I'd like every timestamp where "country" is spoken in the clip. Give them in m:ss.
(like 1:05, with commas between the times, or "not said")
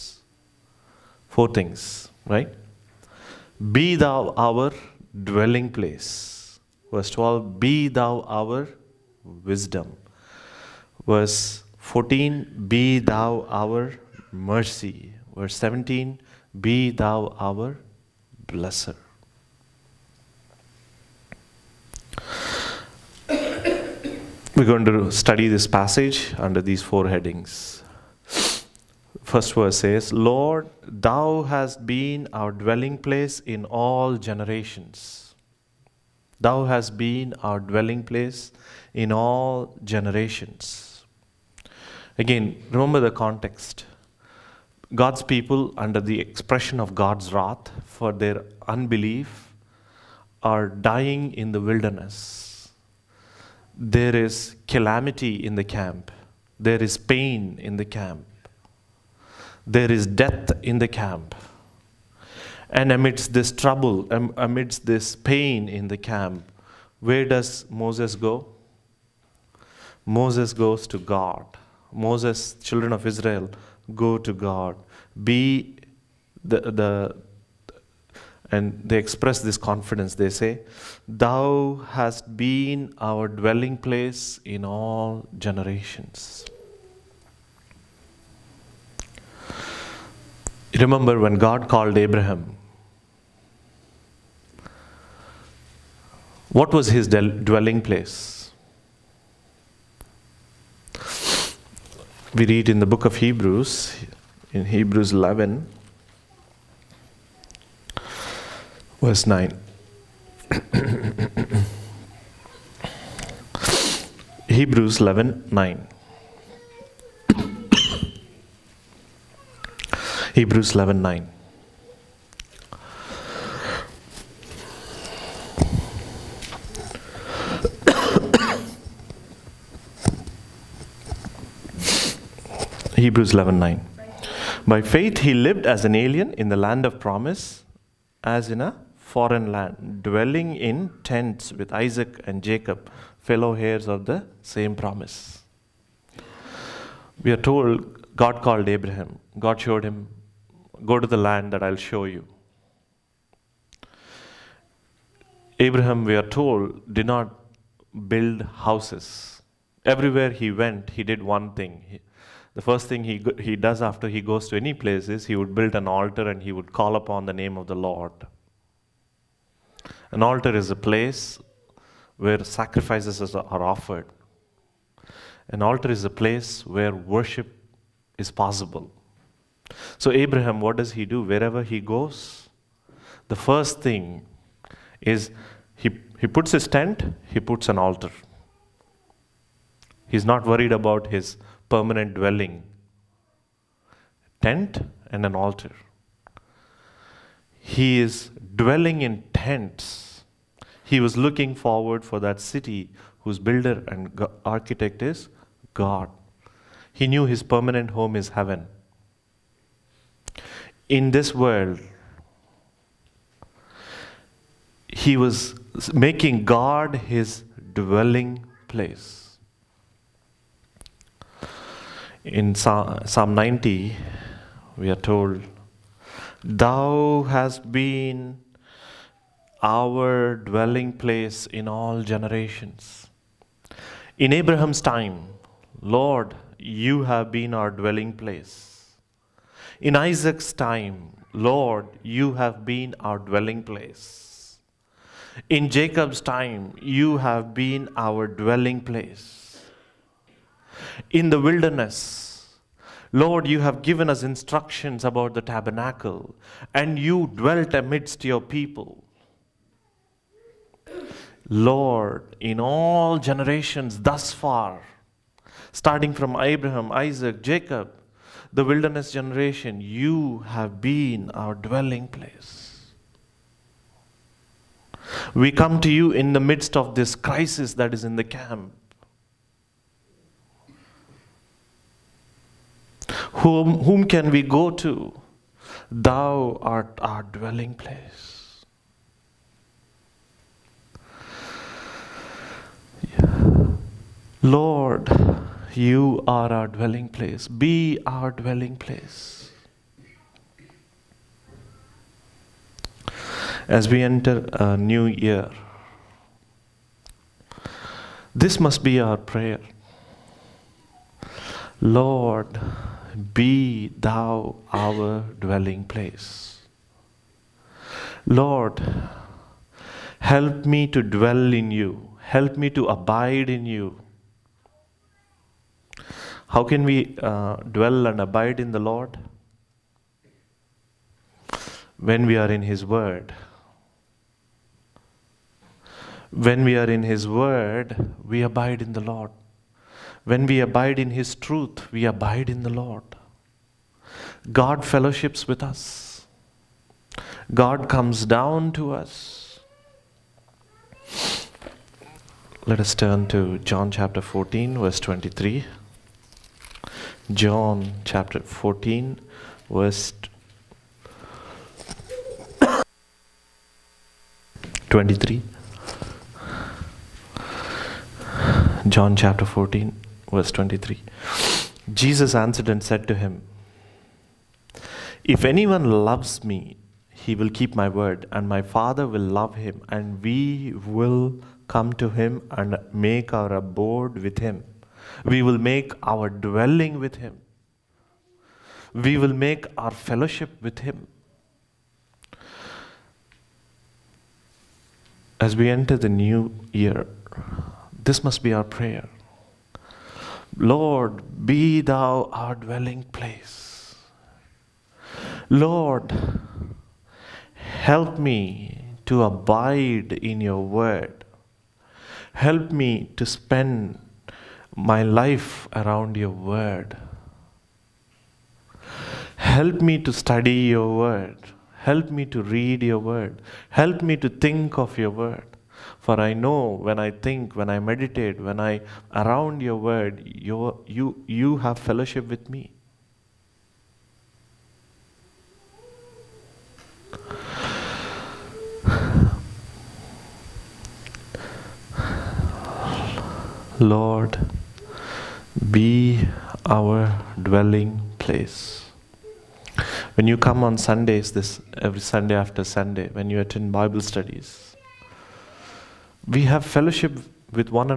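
not said.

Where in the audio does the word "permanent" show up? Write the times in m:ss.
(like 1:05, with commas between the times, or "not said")
3:11, 3:27.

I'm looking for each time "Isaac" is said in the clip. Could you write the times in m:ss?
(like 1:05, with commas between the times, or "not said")
2:21, 3:59, 4:26.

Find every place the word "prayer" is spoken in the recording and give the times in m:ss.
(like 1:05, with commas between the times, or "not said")
5:09, 6:38.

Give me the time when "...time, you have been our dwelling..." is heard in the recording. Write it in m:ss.
4:06.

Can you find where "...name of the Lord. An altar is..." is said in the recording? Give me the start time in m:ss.
2:47.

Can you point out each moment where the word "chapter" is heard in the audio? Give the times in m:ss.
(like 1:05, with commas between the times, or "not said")
5:53, 5:58, 6:09.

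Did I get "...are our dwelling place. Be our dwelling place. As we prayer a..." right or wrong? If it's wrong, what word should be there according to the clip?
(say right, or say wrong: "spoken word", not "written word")
wrong: "enter", not "prayer".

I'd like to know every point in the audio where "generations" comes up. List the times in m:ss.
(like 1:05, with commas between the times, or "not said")
0:34, 0:39, 1:25, 3:52, 4:23, 4:29.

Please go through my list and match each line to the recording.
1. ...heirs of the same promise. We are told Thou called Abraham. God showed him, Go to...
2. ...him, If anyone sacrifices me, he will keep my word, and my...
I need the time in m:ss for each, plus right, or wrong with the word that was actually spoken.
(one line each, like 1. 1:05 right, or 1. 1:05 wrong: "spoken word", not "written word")
1. 2:23 wrong: "God", not "Thou"
2. 6:13 wrong: "loves", not "sacrifices".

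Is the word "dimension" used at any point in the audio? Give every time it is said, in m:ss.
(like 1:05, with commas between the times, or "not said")
not said.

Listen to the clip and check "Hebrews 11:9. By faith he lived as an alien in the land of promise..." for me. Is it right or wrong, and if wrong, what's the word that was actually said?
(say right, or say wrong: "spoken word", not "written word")
right.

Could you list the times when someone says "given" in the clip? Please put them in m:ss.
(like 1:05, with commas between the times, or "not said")
4:13.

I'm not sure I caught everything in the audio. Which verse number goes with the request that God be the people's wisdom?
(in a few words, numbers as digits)
12.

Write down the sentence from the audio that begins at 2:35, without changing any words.
Abraham, we are told, did not build houses.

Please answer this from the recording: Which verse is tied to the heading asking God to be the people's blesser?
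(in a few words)
17.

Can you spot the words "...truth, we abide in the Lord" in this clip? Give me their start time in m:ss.
5:41.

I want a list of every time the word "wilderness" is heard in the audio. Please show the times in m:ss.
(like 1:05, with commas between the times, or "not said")
0:51, 4:11, 4:28.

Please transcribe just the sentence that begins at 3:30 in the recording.
In this world, he was making God his dwelling place.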